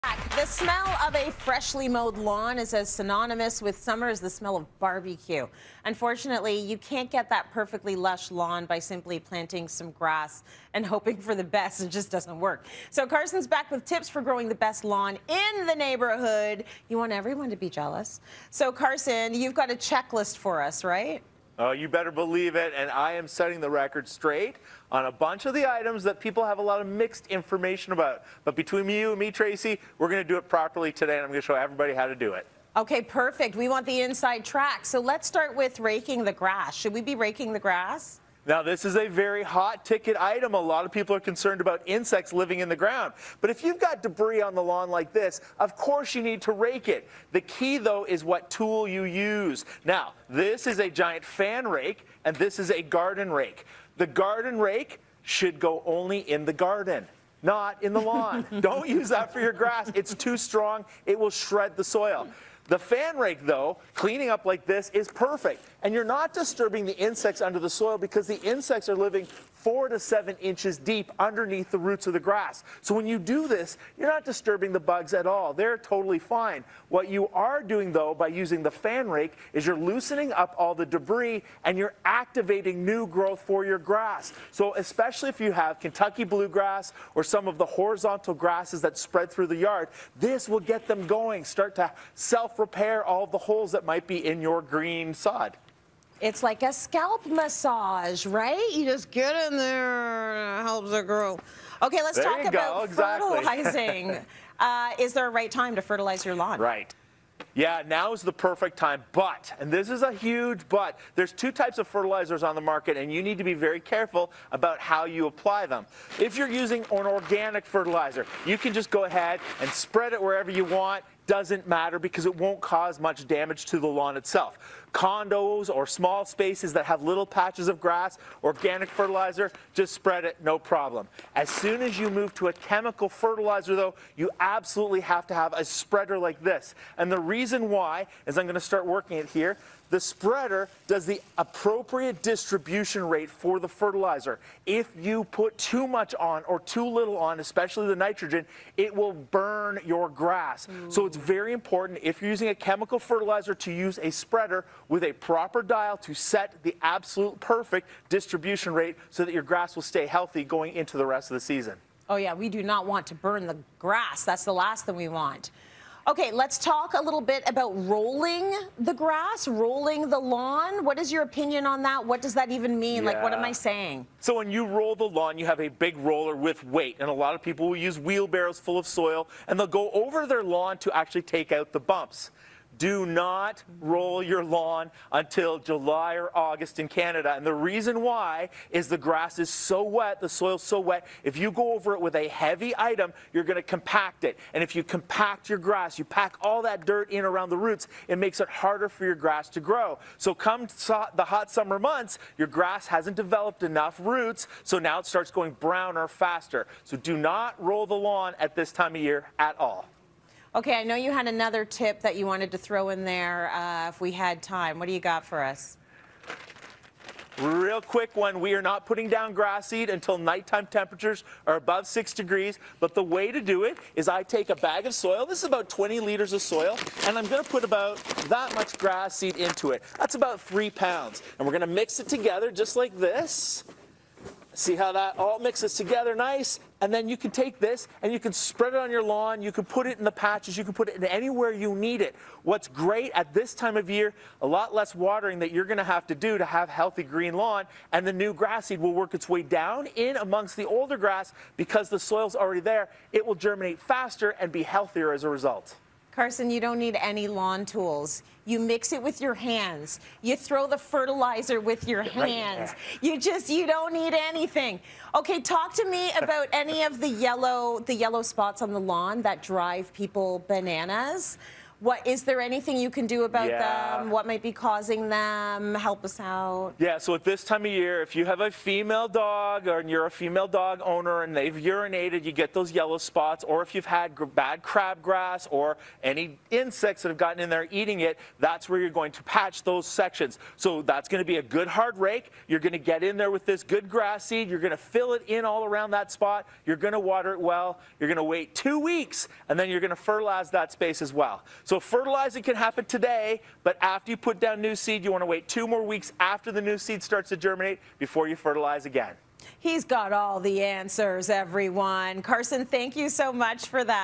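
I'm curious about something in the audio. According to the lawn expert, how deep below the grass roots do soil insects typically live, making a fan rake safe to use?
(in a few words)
4 to 7 inches.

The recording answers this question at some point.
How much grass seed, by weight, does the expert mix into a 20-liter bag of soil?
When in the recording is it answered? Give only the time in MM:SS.
03:50.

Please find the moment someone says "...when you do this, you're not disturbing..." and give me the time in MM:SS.
01:12.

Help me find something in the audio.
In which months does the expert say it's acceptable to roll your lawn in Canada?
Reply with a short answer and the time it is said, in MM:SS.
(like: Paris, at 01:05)
July or August, at 03:05.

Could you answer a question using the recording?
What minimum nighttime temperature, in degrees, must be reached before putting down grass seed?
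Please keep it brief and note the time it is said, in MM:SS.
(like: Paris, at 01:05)
6, at 03:41.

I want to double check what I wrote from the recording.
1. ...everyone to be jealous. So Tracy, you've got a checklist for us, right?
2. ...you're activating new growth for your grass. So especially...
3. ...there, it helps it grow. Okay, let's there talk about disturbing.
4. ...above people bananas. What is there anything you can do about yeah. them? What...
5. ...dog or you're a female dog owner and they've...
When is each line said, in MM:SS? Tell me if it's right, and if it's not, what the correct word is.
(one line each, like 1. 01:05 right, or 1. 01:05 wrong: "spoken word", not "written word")
1. 00:17 wrong: "Carson", not "Tracy"
2. 01:21 right
3. 01:39 wrong: "fertilizing", not "disturbing"
4. 04:29 wrong: "drive", not "above"
5. 04:39 right.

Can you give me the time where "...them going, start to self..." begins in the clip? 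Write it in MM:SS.
01:30.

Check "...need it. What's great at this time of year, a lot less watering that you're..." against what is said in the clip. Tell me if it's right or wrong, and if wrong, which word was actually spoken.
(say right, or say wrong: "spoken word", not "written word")
right.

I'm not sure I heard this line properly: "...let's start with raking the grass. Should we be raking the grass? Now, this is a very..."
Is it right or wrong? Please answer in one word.
right.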